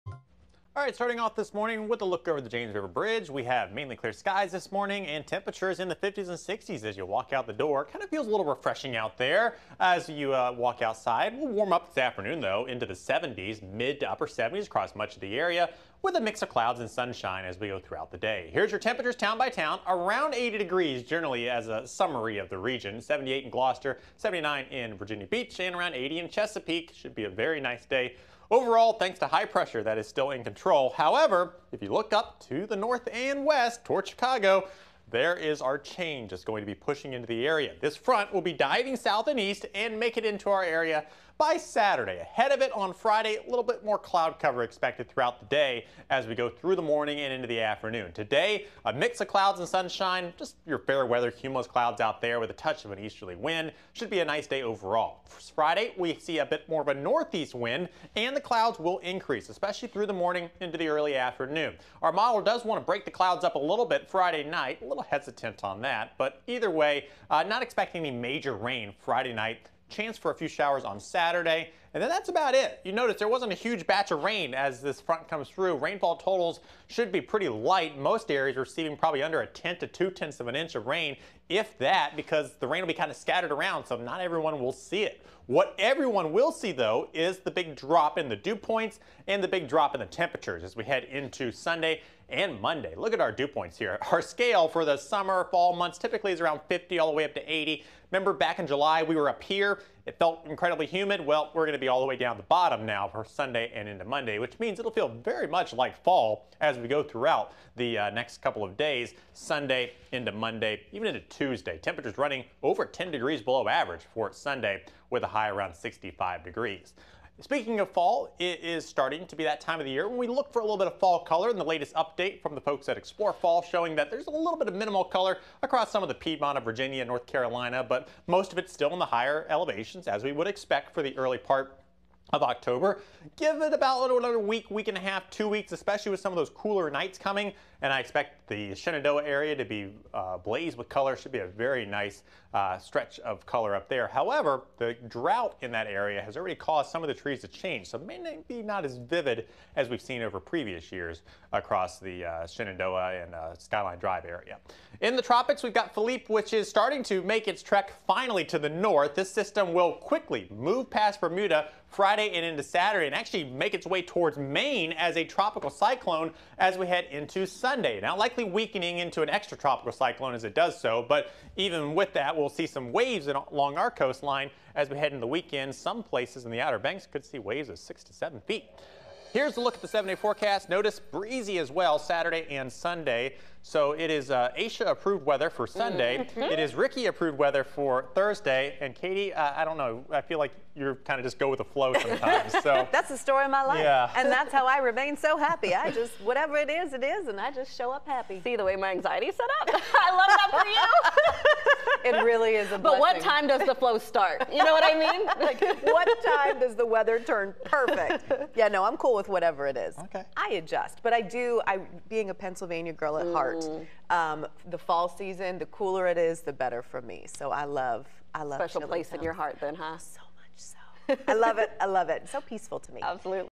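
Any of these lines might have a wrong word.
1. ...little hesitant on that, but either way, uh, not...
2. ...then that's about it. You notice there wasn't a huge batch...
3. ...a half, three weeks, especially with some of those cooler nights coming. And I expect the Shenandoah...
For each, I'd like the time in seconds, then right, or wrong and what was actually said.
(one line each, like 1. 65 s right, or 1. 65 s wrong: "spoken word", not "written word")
1. 64 s right
2. 72 s right
3. 134 s wrong: "two", not "three".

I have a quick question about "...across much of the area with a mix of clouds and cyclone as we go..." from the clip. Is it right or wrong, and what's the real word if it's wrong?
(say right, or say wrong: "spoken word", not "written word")
wrong: "sunshine", not "cyclone".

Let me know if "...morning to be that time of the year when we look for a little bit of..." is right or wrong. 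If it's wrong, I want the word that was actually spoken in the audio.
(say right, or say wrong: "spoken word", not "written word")
wrong: "starting", not "morning".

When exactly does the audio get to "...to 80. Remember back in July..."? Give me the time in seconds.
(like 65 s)
97 s.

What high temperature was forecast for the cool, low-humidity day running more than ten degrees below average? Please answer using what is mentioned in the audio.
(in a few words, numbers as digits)
65 degrees.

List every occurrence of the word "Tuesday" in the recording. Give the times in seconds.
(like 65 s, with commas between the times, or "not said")
111 s.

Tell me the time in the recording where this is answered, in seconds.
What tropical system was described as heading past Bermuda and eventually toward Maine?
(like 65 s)
155 s.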